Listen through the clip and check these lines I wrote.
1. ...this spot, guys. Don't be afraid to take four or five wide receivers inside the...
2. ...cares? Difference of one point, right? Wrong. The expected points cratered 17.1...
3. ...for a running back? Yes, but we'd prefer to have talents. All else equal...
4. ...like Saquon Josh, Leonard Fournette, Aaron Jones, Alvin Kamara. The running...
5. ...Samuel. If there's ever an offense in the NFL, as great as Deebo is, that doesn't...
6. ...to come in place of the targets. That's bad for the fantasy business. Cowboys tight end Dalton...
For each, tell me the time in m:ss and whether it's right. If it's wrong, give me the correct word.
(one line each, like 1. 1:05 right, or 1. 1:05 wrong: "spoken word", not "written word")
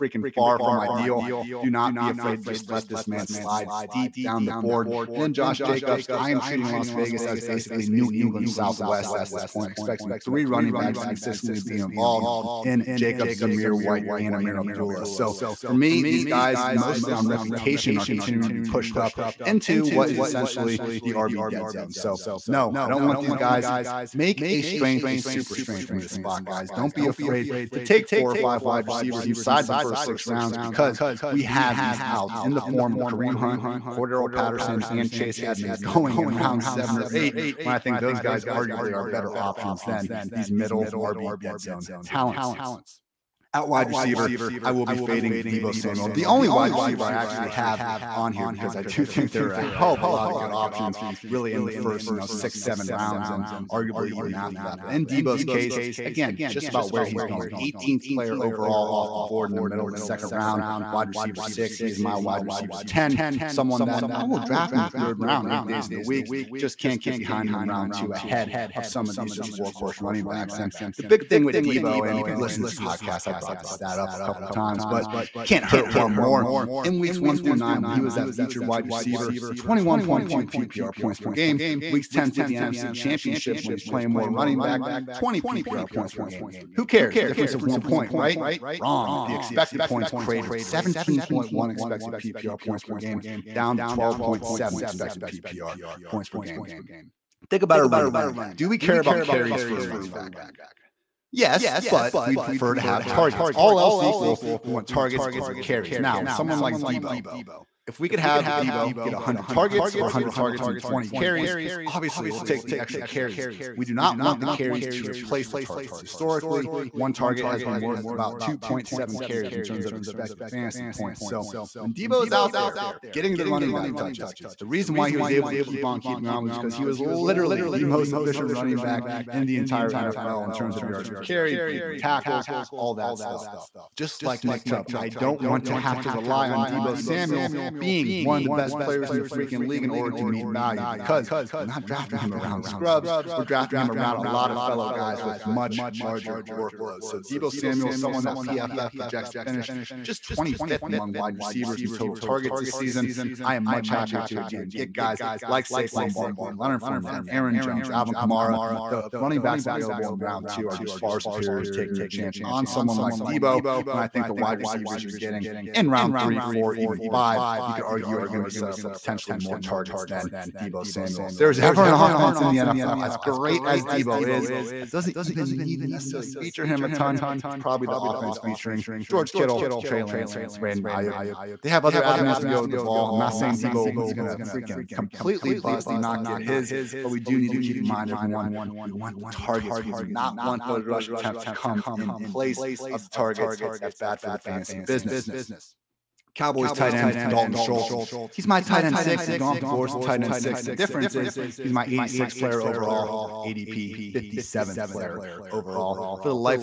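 1. 0:25 right
2. 1:26 right
3. 1:39 wrong: "targets", not "talents"
4. 2:35 wrong: "Barkley", not "Josh"
5. 2:50 right
6. 3:11 right.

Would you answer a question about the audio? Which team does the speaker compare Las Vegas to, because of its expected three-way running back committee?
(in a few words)
New England Southwest.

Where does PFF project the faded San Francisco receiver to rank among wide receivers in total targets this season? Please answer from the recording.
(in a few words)
25th.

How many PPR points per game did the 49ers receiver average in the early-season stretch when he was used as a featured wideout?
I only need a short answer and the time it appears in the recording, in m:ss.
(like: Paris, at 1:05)
21.2, at 1:19.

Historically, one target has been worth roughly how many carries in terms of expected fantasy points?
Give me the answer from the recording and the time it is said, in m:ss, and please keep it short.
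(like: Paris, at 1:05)
2.7, at 1:58.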